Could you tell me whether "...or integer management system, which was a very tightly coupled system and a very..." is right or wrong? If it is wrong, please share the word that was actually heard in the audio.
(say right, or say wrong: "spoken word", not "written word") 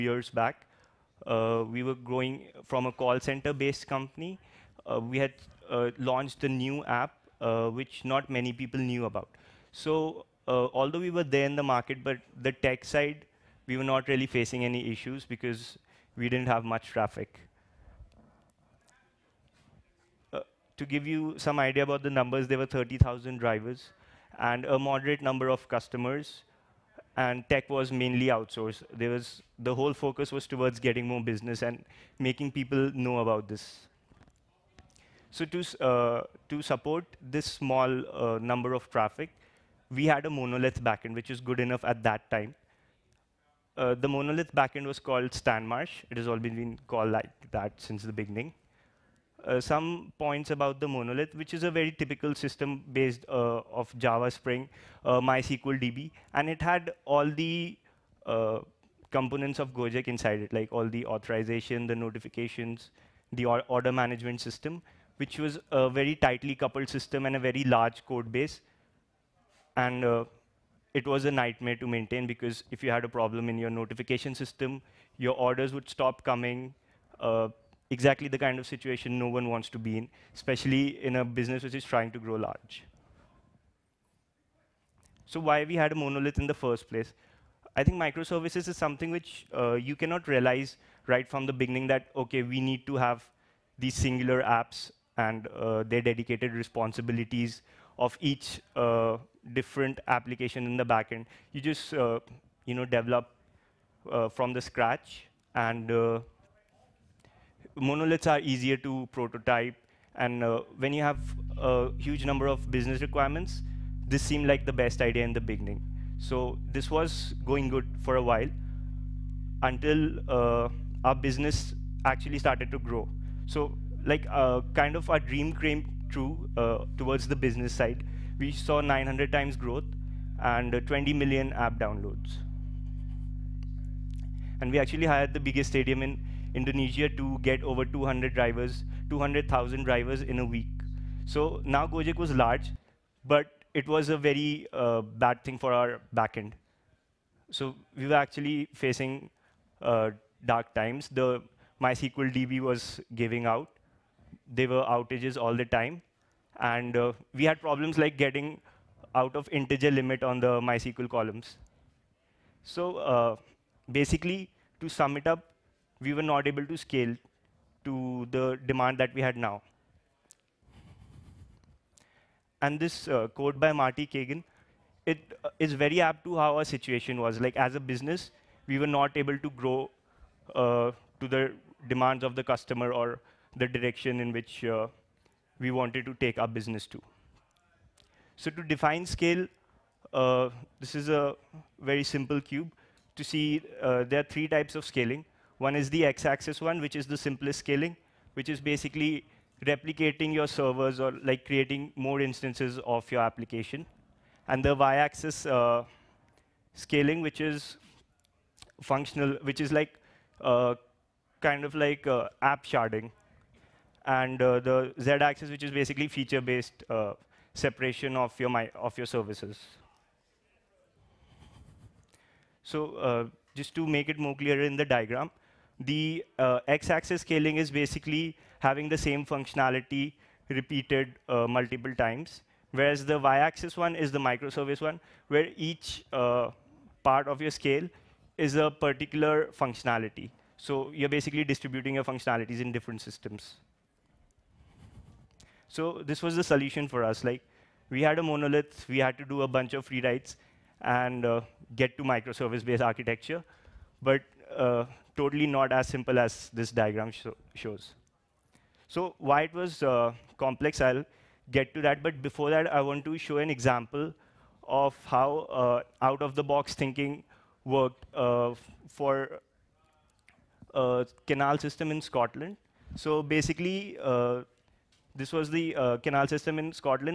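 wrong: "order", not "integer".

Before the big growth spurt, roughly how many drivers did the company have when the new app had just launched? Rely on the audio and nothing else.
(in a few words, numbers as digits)
30,000.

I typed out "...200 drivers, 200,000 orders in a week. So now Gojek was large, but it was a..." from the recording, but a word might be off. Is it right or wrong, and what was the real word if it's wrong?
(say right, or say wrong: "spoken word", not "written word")
wrong: "drivers", not "orders".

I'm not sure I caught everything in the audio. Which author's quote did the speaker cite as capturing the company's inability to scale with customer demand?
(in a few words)
Marty Cagan.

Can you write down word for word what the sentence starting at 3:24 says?
And the y-axis uh, scaling, which is functional, which is like uh, kind of like uh, app sharding.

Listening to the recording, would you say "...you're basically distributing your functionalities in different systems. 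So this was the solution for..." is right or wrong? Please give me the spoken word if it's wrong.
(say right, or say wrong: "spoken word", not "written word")
right.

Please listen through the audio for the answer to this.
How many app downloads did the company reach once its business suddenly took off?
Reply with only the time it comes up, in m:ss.
2:10.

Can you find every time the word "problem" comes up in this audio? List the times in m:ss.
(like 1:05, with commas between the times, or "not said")
1:13, 2:37.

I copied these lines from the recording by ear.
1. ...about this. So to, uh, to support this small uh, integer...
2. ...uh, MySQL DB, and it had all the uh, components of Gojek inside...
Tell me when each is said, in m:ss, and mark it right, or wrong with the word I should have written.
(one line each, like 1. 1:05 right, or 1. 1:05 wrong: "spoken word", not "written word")
1. 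0:33 wrong: "number", not "integer"
2. 0:55 right.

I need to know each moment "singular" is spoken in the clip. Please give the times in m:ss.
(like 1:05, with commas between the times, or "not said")
1:33.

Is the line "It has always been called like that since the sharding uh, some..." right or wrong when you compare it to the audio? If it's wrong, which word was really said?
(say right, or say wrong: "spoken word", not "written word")
wrong: "beginning", not "sharding".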